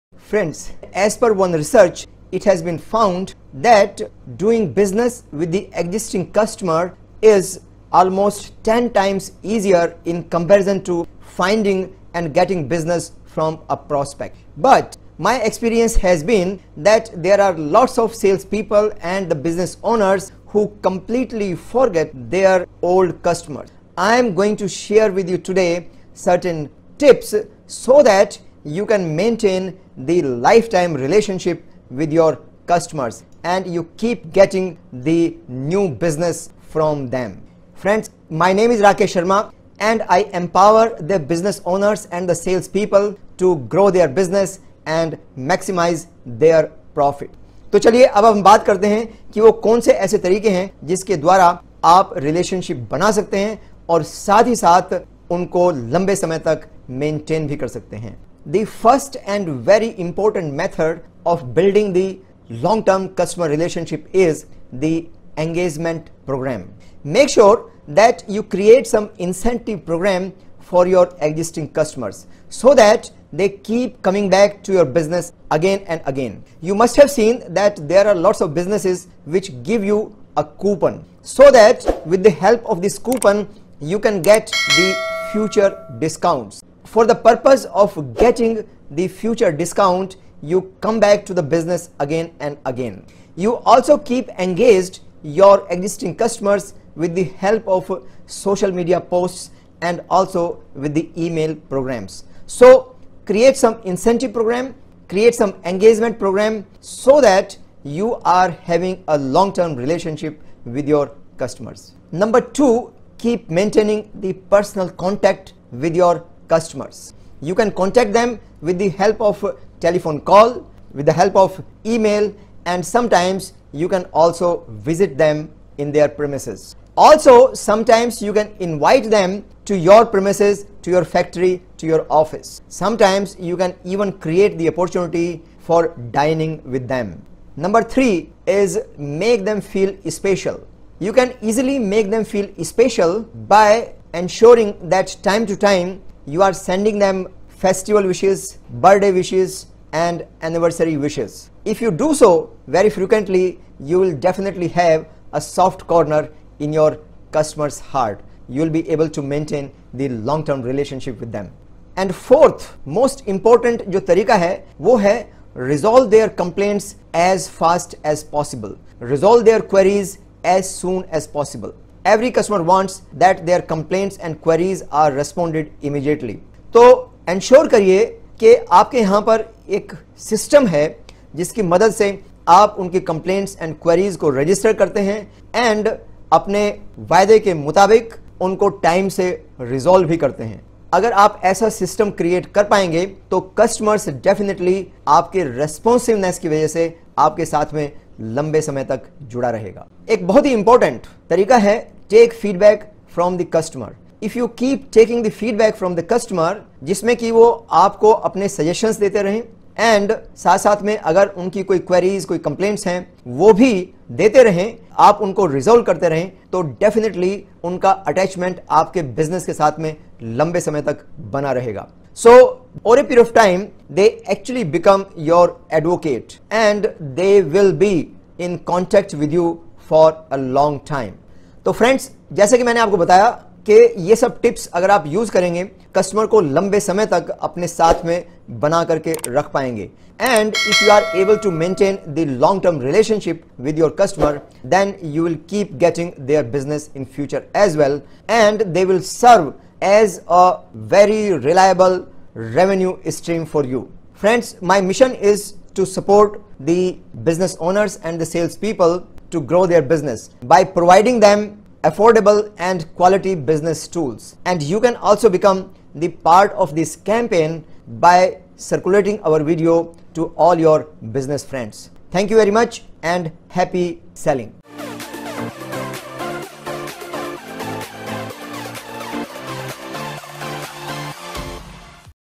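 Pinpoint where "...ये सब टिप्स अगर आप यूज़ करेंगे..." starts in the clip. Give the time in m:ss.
3:54.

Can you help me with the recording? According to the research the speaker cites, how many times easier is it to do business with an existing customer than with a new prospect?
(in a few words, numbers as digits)
10 times.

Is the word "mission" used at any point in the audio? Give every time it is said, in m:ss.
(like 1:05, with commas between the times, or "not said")
4:14.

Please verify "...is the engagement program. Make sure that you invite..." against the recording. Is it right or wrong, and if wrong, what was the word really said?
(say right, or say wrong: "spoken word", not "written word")
wrong: "create", not "invite".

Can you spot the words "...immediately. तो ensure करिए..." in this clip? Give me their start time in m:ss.
2:55.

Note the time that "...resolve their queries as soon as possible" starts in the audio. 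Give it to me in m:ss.
2:48.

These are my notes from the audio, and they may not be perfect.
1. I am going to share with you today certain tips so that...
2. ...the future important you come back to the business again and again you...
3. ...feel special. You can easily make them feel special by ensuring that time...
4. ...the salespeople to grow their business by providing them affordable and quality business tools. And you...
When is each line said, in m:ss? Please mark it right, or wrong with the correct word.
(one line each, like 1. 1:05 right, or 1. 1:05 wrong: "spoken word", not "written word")
1. 0:23 right
2. 1:28 wrong: "discount", not "important"
3. 2:19 right
4. 4:18 right.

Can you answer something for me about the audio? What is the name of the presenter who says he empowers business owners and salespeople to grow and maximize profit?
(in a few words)
Rakesh Sharma.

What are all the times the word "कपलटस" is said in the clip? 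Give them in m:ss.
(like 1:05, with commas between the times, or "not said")
3:03, 3:32.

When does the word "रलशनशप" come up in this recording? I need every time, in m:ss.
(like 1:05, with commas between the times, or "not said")
0:52, 4:02.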